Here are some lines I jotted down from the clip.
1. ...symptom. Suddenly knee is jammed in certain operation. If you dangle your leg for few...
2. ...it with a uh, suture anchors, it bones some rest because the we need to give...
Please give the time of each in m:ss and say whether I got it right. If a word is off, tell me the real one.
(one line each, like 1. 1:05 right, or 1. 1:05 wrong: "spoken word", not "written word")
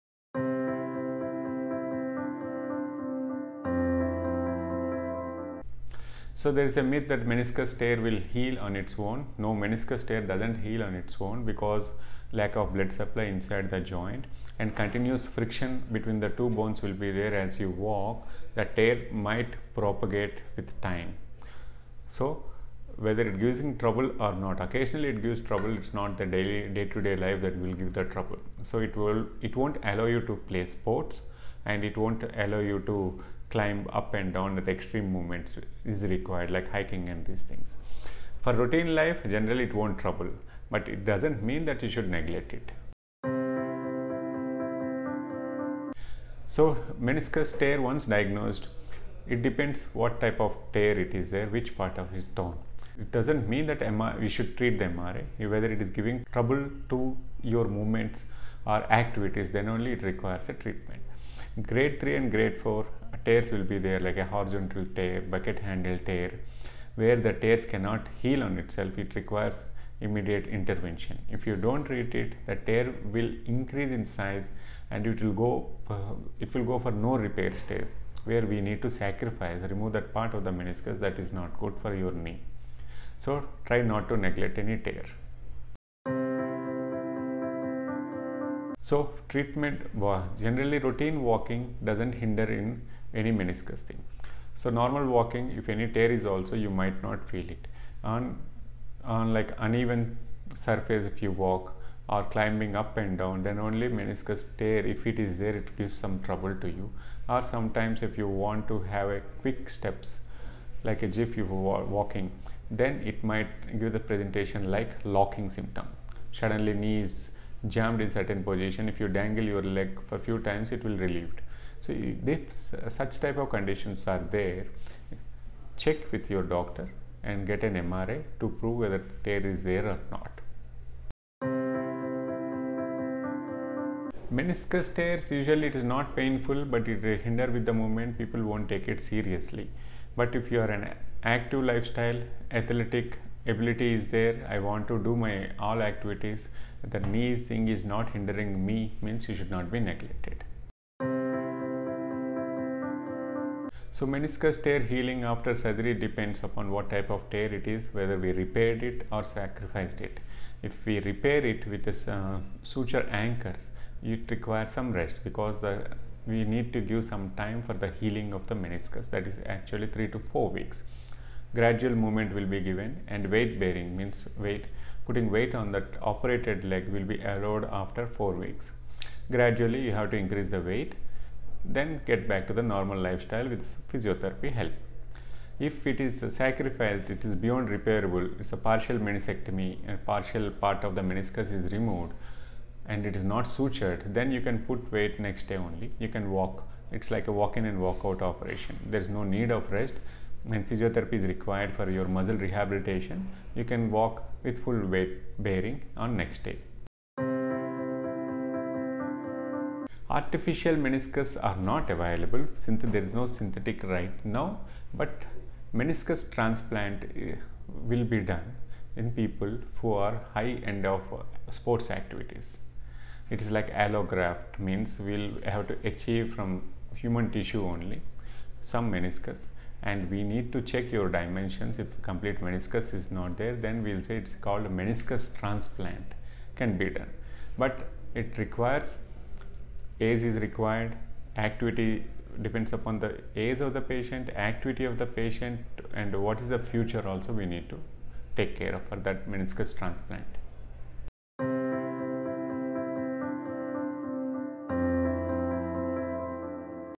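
1. 1:55 wrong: "position", not "operation"
2. 2:41 wrong: "requires", not "bones".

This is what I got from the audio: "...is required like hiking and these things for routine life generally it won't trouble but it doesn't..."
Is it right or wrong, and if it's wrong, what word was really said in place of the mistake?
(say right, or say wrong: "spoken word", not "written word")
right.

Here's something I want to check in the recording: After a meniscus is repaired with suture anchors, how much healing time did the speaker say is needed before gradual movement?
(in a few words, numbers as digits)
3 to 4 weeks.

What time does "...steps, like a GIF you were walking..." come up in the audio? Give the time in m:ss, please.
1:49.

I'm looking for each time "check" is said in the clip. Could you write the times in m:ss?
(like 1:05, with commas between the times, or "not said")
2:05, 3:50.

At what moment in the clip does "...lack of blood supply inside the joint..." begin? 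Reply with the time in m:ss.
0:12.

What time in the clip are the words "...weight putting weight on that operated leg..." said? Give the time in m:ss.
2:54.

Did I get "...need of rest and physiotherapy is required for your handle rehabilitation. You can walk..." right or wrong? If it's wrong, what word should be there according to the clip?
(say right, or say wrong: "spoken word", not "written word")
wrong: "muscle", not "handle".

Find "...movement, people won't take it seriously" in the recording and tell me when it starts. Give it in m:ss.
2:17.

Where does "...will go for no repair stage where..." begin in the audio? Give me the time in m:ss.
1:16.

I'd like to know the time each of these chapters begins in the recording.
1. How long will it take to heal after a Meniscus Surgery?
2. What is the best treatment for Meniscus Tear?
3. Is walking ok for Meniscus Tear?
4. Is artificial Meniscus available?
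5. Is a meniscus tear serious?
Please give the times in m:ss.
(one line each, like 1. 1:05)
1. 2:30
2. 0:43
3. 1:25
4. 3:27
5. 2:12.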